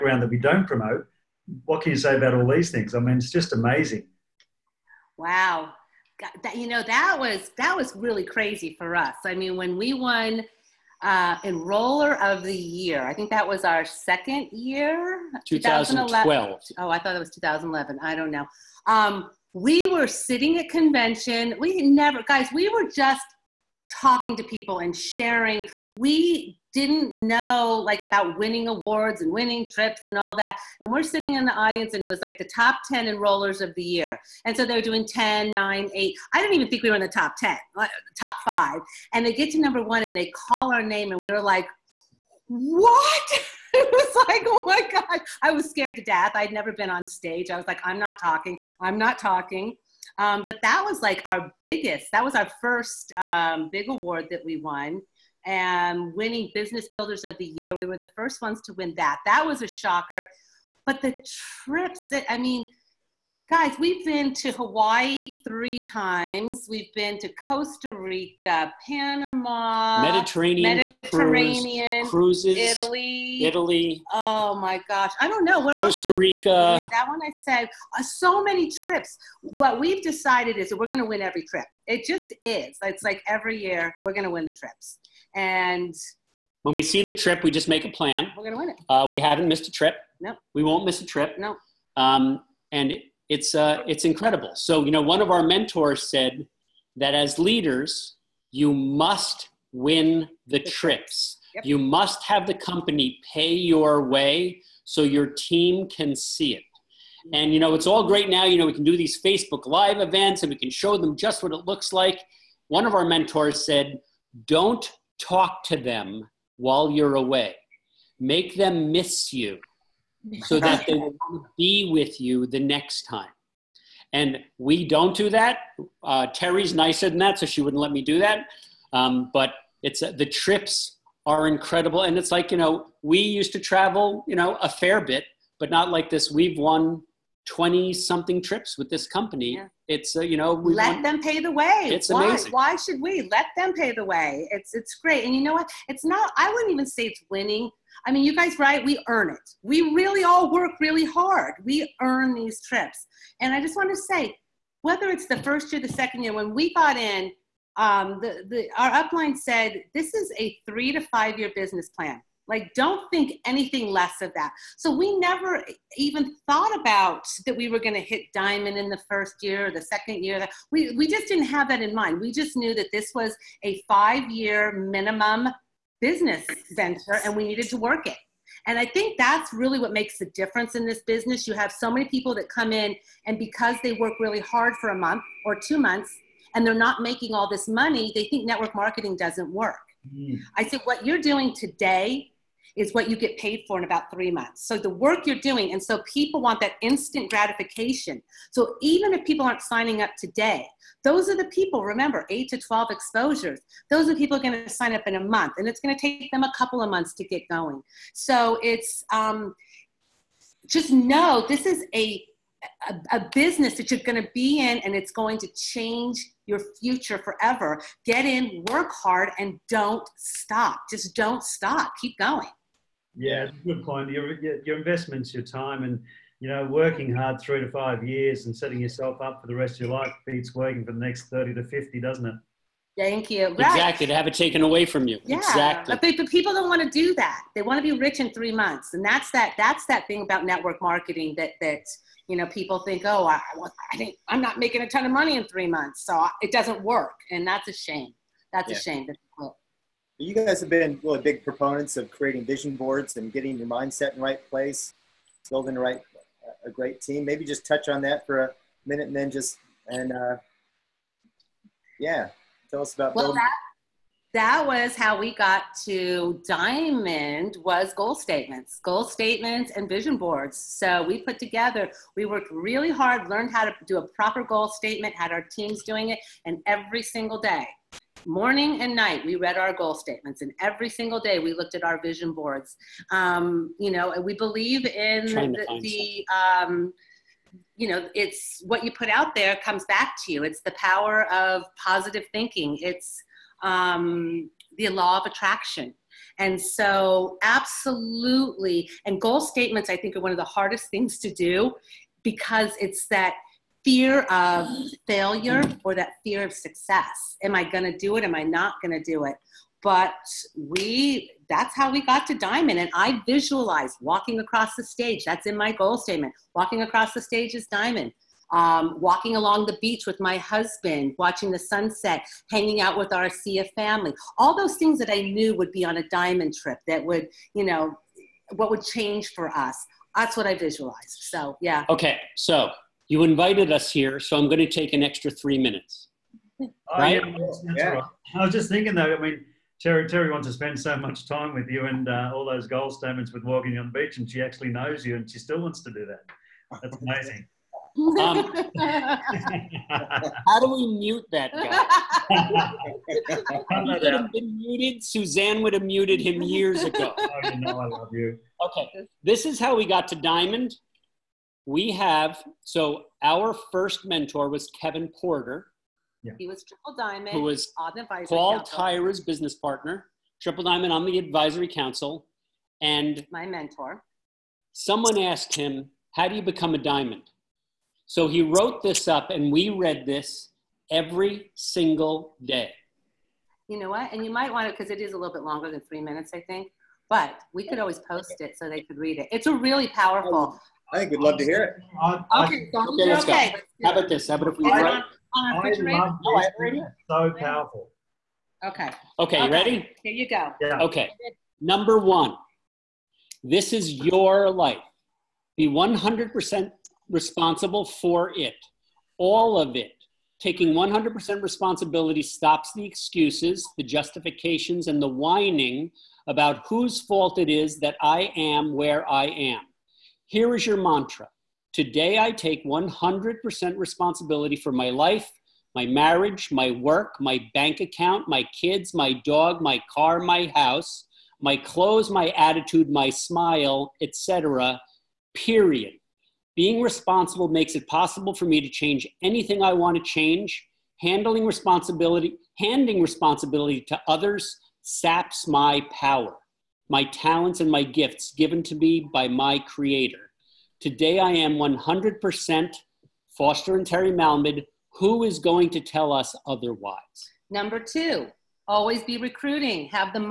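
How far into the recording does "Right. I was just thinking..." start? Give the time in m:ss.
5:37.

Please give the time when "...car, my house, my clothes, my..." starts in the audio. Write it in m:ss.
7:09.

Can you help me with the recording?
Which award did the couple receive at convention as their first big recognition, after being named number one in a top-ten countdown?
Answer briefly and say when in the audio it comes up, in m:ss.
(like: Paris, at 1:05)
Enroller of the year, at 0:11.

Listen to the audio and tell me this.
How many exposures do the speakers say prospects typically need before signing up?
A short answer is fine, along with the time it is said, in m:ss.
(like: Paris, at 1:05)
8 to 12, at 3:22.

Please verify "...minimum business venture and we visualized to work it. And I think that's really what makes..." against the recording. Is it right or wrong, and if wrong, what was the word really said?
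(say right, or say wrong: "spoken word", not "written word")
wrong: "needed", not "visualized".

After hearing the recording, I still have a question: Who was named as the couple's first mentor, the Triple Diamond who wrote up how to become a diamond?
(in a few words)
Kevin Porter.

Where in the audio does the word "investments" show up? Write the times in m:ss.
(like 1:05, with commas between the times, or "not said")
3:44.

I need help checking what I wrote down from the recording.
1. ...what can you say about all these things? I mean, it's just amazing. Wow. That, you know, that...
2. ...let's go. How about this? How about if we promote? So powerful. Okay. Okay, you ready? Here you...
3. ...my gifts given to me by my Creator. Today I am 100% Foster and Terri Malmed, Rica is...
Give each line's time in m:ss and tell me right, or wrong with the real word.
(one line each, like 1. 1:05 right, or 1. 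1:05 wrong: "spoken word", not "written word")
1. 0:01 right
2. 6:33 wrong: "write", not "promote"
3. 7:27 wrong: "Who", not "Rica".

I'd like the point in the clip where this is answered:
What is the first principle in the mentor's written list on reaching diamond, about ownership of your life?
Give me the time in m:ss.
6:45.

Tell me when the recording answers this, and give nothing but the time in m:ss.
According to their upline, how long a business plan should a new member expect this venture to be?
2:40.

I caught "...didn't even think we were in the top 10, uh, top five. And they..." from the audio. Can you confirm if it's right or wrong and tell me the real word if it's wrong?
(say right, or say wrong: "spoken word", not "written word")
right.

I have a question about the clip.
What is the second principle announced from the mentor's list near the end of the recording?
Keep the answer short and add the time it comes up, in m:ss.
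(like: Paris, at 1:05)
Always be recruiting, at 7:38.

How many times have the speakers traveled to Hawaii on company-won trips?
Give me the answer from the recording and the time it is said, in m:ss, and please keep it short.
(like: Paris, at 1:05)
3, at 1:05.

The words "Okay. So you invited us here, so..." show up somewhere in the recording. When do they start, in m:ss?
5:31.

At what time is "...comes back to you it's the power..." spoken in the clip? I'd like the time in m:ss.
4:49.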